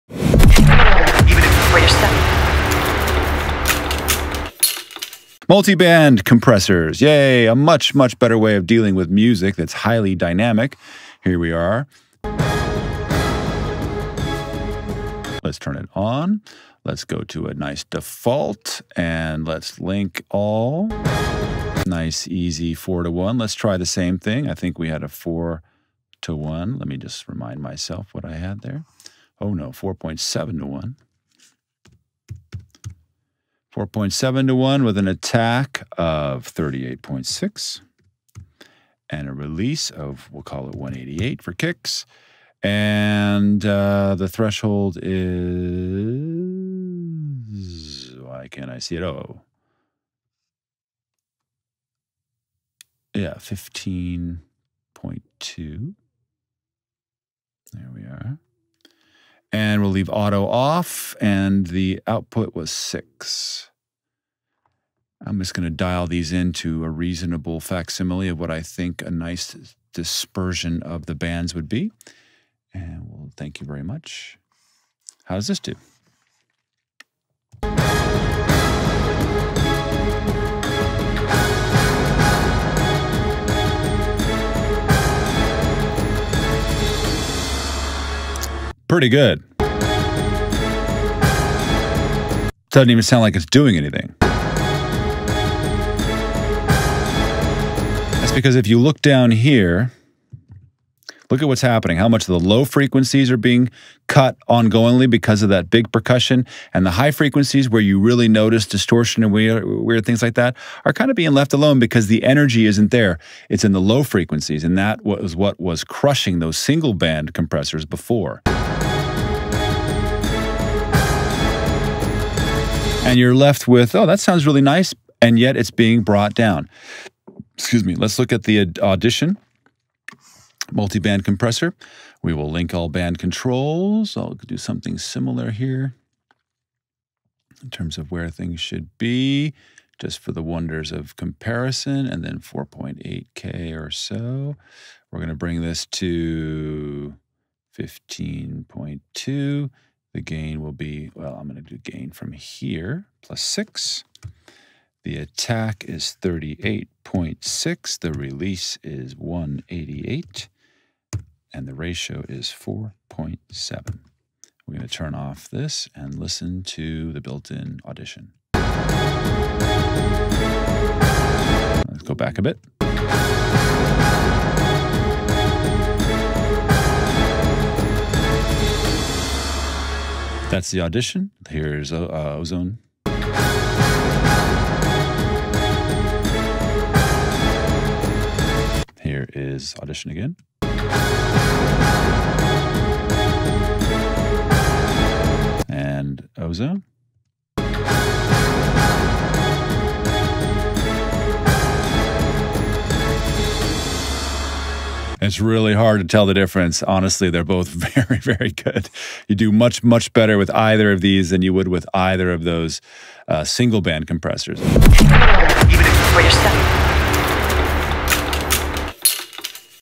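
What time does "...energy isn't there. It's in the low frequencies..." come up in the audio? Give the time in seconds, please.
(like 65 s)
112 s.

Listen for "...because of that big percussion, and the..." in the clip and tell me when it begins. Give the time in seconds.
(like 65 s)
105 s.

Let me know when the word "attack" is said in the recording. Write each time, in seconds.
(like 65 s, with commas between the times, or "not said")
35 s, 155 s.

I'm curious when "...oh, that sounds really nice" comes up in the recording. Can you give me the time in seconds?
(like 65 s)
123 s.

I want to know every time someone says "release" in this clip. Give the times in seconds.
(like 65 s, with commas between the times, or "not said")
39 s, 158 s.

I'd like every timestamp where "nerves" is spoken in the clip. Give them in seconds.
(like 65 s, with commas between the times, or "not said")
not said.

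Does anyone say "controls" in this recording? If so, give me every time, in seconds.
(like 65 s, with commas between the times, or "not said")
133 s.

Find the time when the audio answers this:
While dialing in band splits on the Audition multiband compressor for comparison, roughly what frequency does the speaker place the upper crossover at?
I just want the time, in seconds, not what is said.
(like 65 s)
142 s.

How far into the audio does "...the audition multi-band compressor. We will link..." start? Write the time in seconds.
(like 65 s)
128 s.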